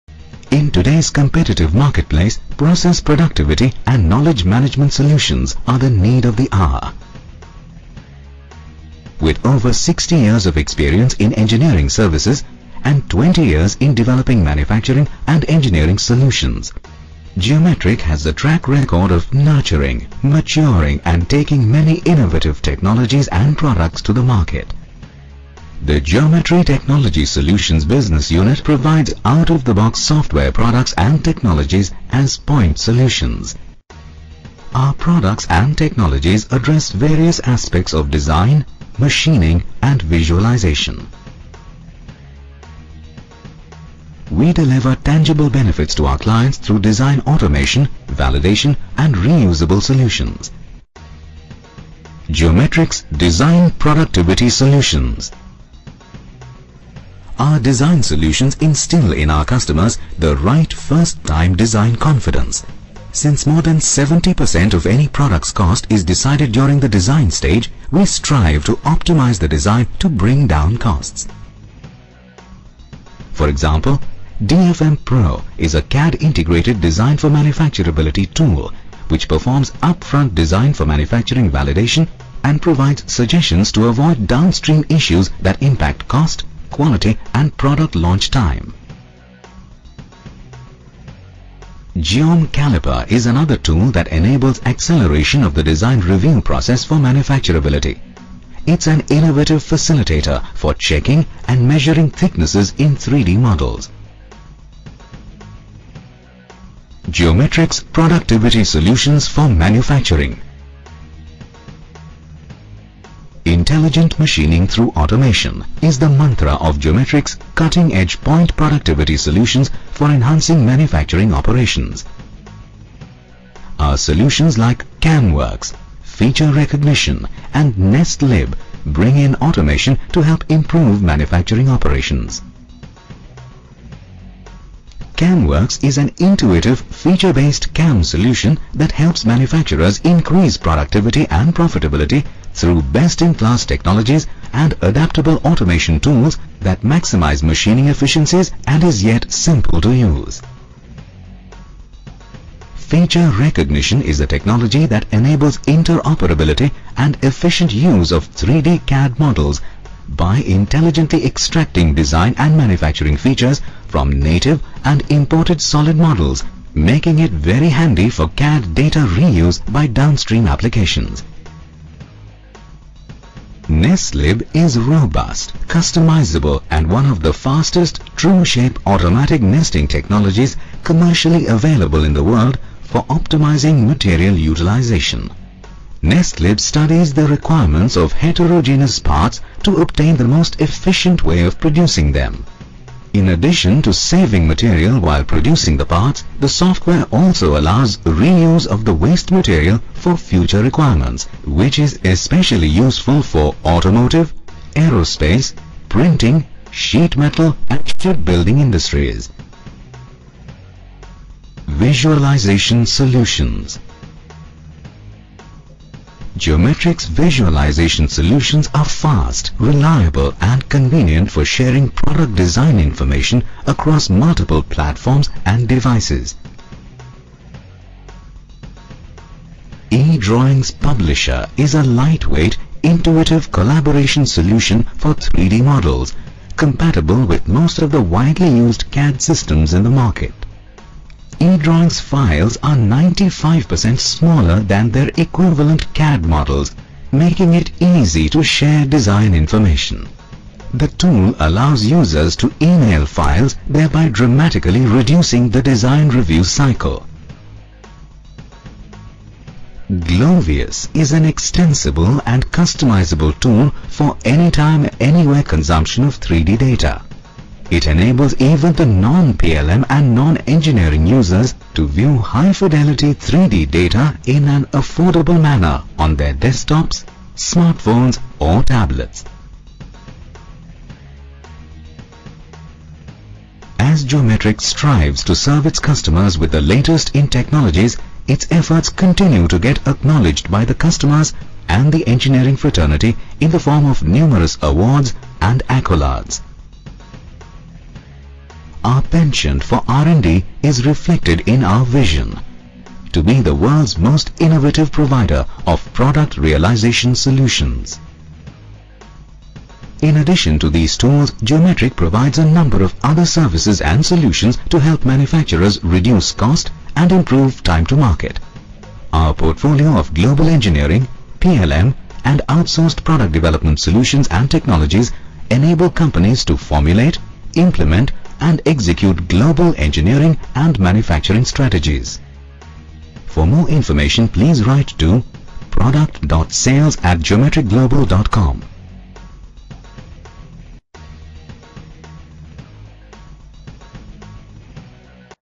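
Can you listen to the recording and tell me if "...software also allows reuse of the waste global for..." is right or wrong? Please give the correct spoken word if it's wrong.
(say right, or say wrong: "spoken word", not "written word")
wrong: "material", not "global".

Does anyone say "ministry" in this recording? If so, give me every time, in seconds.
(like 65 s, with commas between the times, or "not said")
not said.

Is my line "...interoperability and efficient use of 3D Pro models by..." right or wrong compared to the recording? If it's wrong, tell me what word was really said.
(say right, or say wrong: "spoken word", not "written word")
wrong: "CAD", not "Pro".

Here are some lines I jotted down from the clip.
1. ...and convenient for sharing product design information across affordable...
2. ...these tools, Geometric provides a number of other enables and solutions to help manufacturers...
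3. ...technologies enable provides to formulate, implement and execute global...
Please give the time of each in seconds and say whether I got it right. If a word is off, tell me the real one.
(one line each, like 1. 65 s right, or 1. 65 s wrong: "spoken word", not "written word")
1. 220 s wrong: "multiple", not "affordable"
2. 310 s wrong: "services", not "enables"
3. 324 s wrong: "companies", not "provides".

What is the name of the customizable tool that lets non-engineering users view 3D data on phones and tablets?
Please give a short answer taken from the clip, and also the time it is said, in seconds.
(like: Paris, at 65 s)
Glovius, at 259 s.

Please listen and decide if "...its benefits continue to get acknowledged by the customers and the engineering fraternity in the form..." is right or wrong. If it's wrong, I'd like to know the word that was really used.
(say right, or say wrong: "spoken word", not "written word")
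wrong: "efforts", not "benefits".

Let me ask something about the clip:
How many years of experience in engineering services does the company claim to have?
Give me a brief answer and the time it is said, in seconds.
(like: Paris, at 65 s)
60, at 9 s.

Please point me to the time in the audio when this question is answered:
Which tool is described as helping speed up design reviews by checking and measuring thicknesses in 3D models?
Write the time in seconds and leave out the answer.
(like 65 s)
91 s.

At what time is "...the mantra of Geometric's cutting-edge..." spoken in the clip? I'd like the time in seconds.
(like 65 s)
115 s.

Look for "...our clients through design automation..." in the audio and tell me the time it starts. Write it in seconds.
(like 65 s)
46 s.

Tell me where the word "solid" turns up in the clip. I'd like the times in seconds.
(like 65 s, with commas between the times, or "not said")
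165 s.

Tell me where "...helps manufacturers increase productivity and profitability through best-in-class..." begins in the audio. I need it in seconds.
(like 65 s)
138 s.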